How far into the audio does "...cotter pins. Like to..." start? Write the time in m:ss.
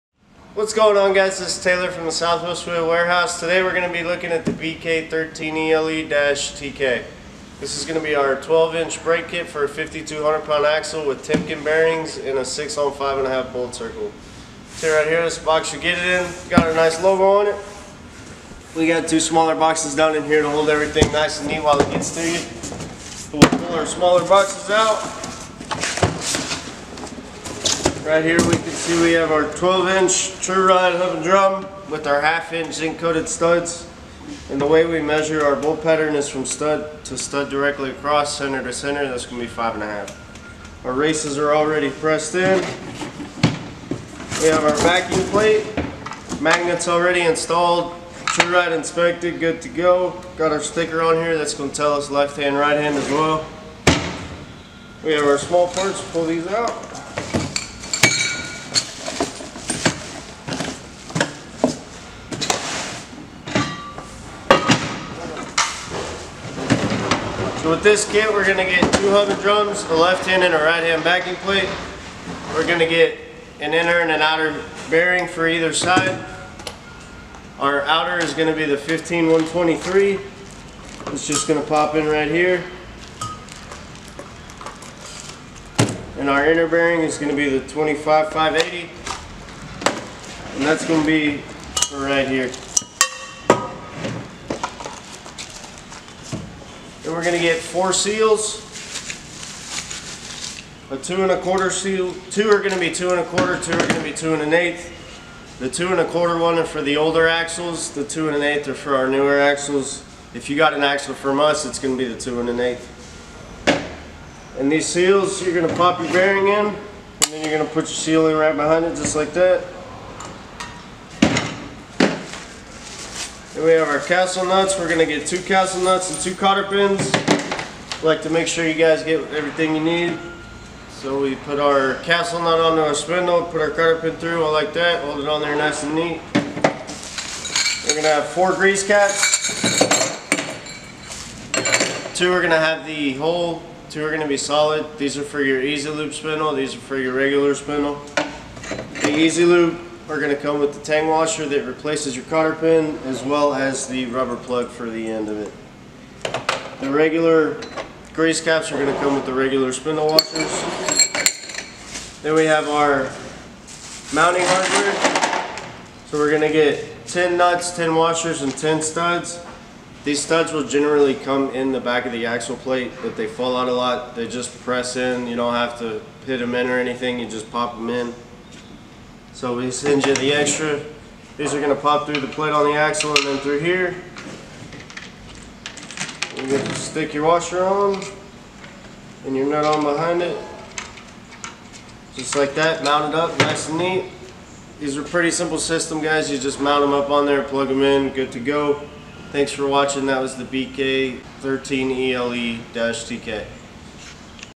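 2:06.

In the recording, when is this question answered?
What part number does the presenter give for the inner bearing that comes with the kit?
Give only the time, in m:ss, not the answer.
1:27.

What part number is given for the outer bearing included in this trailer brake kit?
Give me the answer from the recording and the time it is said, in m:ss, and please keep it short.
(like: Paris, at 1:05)
15123, at 1:18.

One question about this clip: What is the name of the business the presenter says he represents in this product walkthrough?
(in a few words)
Southwest Wheel Warehouse.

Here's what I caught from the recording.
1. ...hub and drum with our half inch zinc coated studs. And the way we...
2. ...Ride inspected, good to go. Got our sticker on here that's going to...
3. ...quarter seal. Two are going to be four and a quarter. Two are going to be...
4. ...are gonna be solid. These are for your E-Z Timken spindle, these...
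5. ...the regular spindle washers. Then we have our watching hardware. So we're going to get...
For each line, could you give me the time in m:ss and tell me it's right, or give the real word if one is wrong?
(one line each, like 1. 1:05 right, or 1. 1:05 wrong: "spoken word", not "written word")
1. 0:30 right
2. 0:48 right
3. 1:41 wrong: "two", not "four"
4. 2:24 wrong: "Lube", not "Timken"
5. 2:39 wrong: "mounting", not "watching".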